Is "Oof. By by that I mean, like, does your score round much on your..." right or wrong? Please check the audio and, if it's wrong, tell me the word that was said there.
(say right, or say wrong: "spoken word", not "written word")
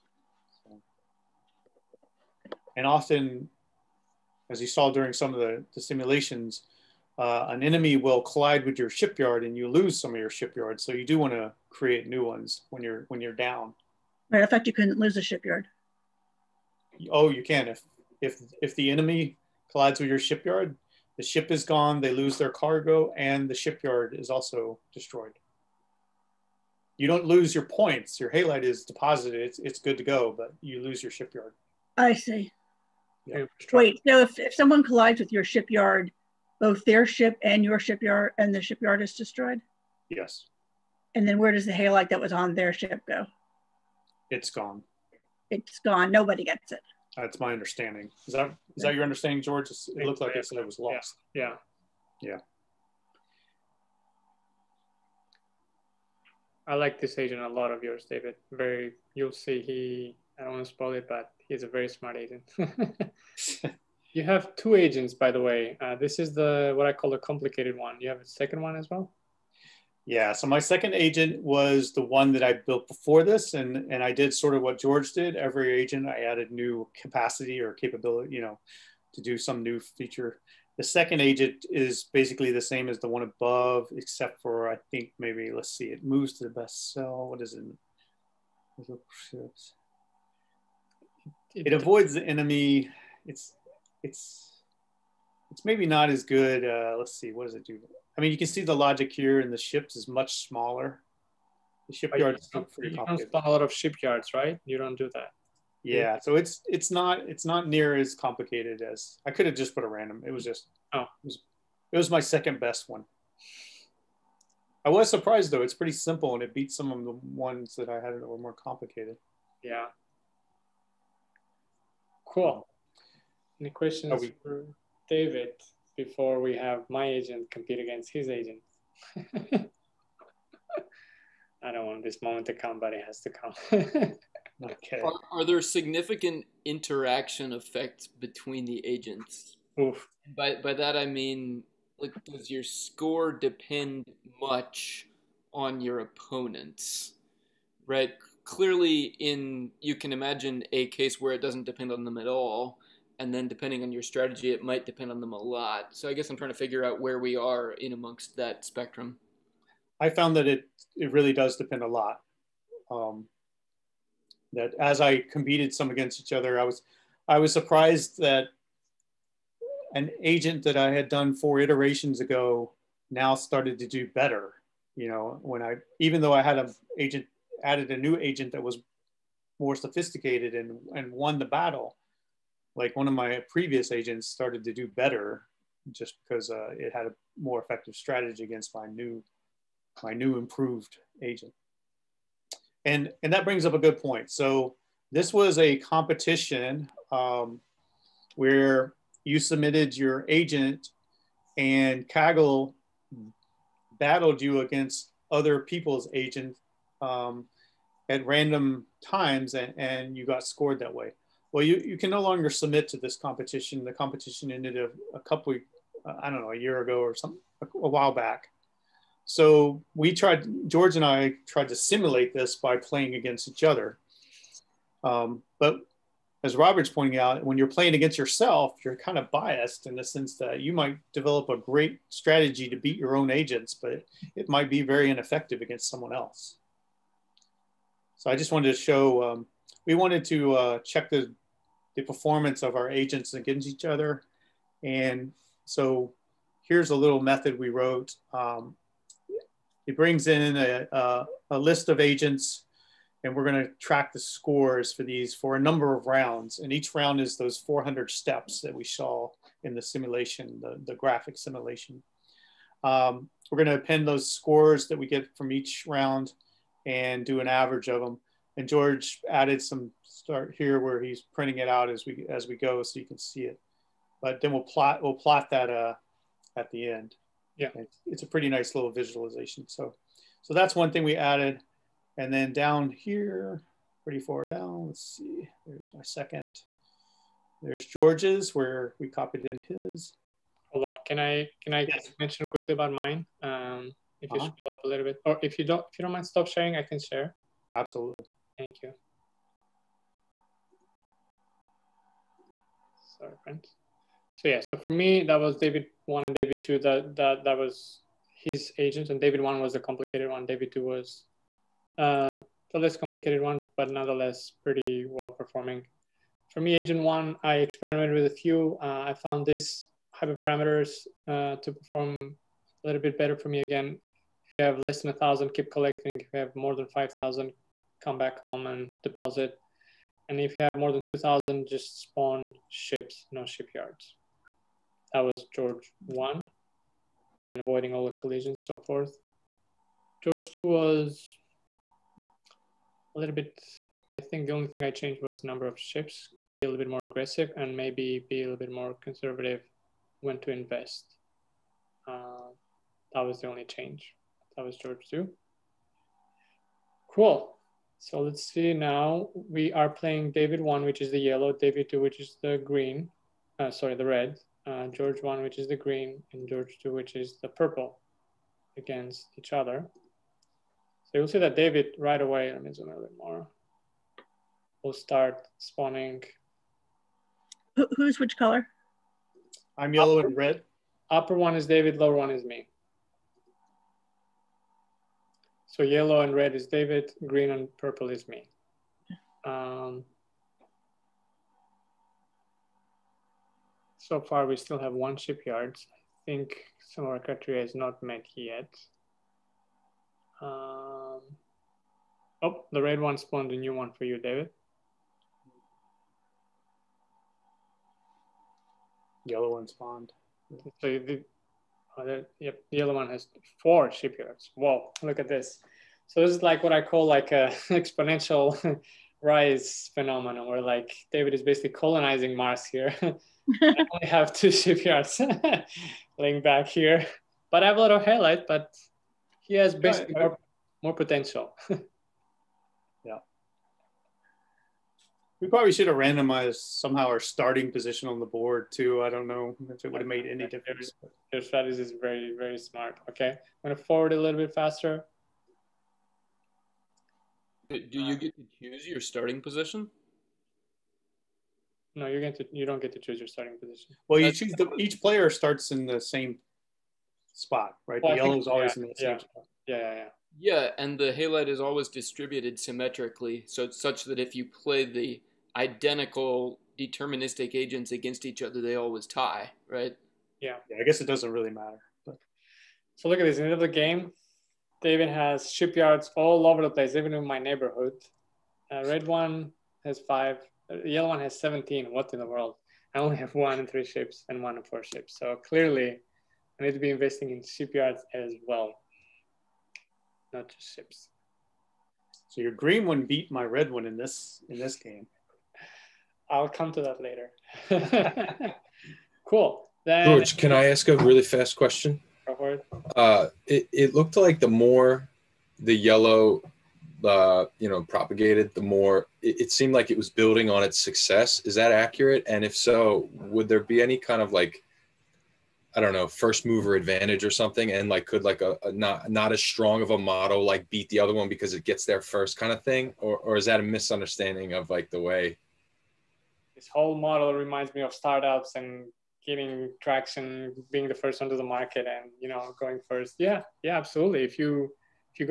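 wrong: "depend", not "round".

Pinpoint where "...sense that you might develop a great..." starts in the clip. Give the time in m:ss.
3:50.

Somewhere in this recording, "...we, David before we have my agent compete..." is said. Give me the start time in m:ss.
2:04.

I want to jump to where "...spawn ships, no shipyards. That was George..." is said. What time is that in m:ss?
5:32.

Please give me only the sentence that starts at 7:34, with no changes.
Well, That's, you choose the, each player starts in the same spot, right?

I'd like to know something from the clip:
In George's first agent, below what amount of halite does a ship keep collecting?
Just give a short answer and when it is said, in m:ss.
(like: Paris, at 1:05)
1000, at 5:25.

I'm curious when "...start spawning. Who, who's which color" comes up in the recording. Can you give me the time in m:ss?
6:14.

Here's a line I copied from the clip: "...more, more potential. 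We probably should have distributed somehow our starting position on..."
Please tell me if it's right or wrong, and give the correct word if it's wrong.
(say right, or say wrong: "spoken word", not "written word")
wrong: "randomized", not "distributed".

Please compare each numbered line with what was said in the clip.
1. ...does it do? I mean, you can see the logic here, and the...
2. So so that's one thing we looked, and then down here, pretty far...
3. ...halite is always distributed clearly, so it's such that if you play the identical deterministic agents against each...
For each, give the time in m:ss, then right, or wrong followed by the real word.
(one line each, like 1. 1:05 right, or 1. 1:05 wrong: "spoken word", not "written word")
1. 1:37 right
2. 4:39 wrong: "added", not "looked"
3. 7:41 wrong: "symmetrically", not "clearly".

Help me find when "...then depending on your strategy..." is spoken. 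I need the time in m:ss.
2:33.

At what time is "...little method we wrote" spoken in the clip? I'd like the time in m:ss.
4:06.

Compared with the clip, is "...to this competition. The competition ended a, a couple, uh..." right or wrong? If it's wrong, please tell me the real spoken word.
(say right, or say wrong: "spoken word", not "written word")
right.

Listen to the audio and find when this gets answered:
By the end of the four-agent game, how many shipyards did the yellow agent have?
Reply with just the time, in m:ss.
8:01.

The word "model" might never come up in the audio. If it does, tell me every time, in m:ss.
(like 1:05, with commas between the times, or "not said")
8:39, 8:46.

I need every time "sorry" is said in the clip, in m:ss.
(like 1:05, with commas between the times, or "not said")
5:03, 6:03.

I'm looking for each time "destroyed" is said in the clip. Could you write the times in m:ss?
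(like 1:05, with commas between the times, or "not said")
0:24, 0:39.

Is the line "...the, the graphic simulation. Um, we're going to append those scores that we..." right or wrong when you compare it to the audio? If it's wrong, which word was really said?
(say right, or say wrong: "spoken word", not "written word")
right.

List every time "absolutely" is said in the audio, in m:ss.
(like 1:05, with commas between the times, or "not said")
4:57, 8:53.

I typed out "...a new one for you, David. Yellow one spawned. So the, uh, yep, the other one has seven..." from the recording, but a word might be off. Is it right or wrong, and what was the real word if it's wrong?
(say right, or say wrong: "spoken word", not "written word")
wrong: "four", not "seven".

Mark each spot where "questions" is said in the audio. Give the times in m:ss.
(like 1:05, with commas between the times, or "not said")
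2:03, 8:21.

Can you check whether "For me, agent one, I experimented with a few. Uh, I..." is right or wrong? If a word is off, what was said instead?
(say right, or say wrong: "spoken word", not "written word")
right.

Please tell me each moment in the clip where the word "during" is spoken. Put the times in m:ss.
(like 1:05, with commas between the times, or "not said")
0:04.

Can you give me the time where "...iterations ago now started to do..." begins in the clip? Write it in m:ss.
2:51.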